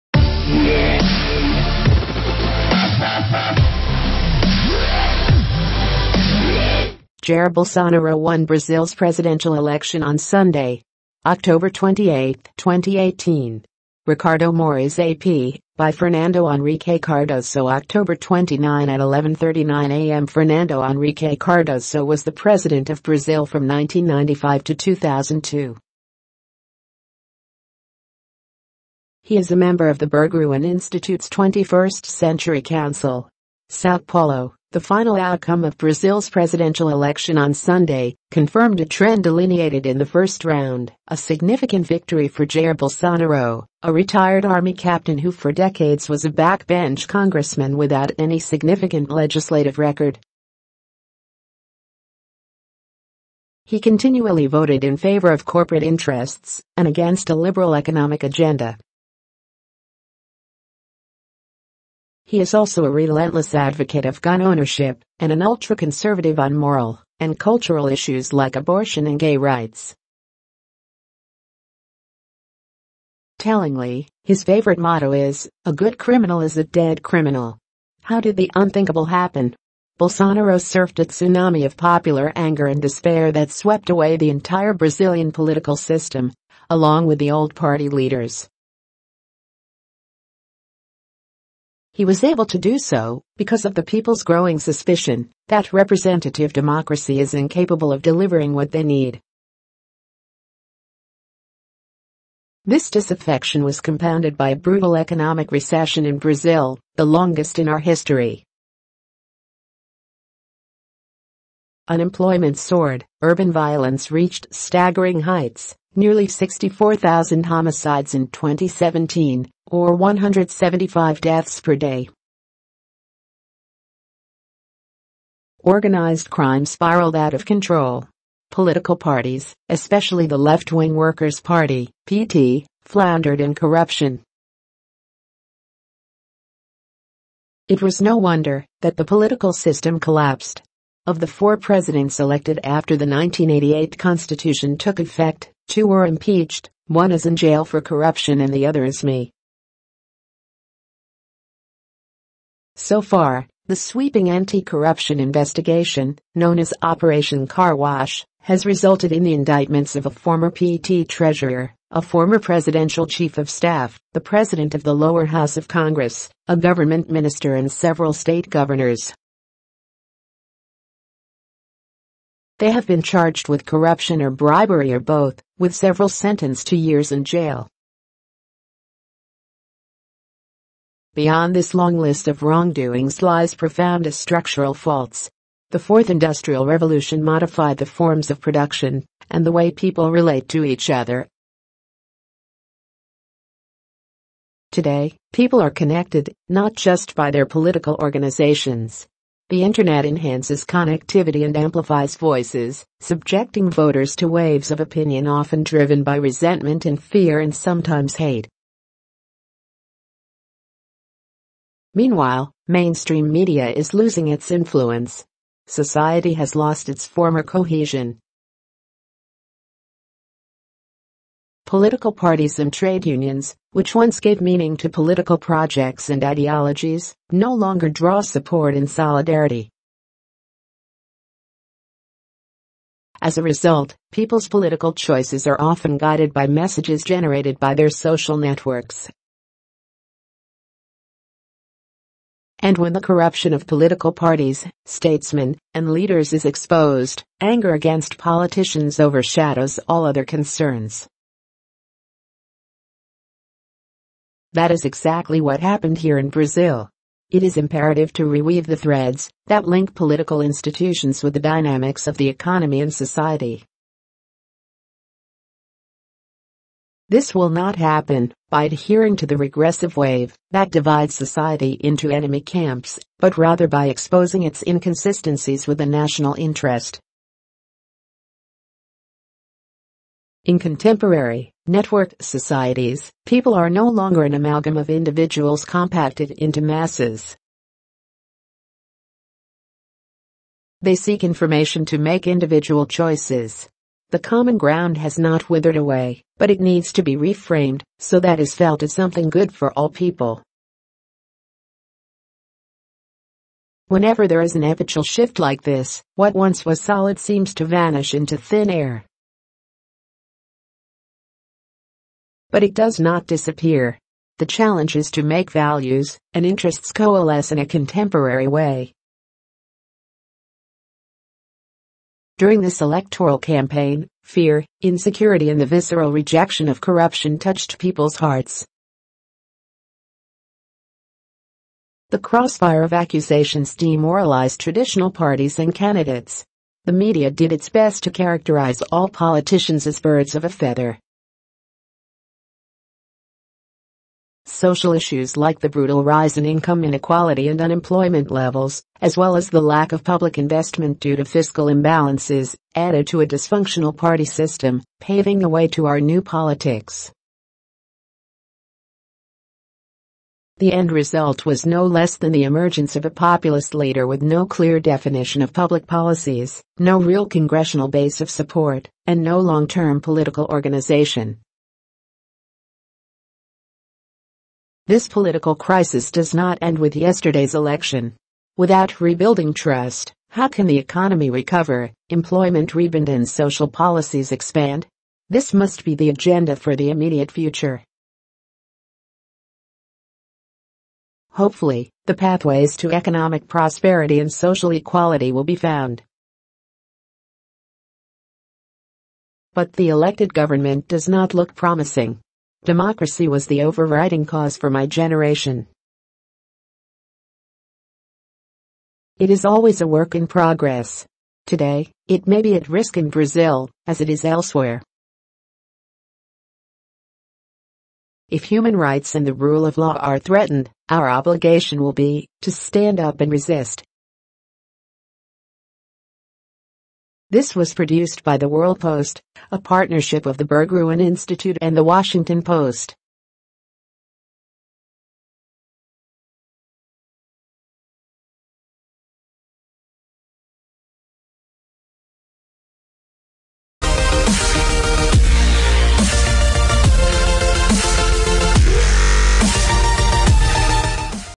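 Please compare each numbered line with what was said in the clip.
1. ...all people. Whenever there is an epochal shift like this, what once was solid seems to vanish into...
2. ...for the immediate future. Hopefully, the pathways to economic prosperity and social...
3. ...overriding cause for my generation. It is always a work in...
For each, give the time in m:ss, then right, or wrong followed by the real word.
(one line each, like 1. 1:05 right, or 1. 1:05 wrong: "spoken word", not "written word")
1. 4:59 right
2. 6:26 right
3. 6:43 right.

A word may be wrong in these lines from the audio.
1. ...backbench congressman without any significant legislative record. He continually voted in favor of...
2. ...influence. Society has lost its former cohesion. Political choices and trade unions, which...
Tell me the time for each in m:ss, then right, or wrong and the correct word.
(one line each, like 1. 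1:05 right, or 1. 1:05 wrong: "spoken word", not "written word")
1. 0:46 right
2. 3:34 wrong: "parties", not "choices".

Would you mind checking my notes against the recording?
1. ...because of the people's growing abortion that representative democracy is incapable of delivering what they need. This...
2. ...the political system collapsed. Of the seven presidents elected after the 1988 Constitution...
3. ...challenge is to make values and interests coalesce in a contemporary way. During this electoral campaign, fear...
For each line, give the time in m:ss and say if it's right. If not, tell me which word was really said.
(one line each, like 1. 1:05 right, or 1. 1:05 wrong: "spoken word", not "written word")
1. 1:33 wrong: "suspicion", not "abortion"
2. 2:18 wrong: "four", not "seven"
3. 5:14 right.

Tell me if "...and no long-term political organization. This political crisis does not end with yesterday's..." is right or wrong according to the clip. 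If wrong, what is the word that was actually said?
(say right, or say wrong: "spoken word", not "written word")
right.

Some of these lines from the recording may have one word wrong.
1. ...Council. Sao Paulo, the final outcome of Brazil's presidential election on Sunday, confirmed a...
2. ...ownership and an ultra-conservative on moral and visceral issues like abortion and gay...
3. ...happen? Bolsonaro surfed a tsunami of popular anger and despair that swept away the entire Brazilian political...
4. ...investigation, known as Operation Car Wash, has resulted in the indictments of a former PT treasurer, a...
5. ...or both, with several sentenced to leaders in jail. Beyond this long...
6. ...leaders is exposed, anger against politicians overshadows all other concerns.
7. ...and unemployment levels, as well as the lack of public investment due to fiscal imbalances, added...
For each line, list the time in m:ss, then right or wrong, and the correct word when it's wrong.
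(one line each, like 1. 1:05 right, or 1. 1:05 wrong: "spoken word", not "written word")
1. 0:32 right
2. 1:04 wrong: "cultural", not "visceral"
3. 1:19 right
4. 2:35 right
5. 2:54 wrong: "years", not "leaders"
6. 4:05 right
7. 5:47 right.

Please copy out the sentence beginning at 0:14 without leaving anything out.
Ricardo Moraes AP, by Fernando Henrique Cardoso October 29 at 11.39 a.m.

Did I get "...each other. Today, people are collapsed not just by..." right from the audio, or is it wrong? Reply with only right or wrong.
wrong.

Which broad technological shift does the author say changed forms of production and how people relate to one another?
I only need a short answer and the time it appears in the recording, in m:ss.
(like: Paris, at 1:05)
Fourth Industrial Revolution, at 3:05.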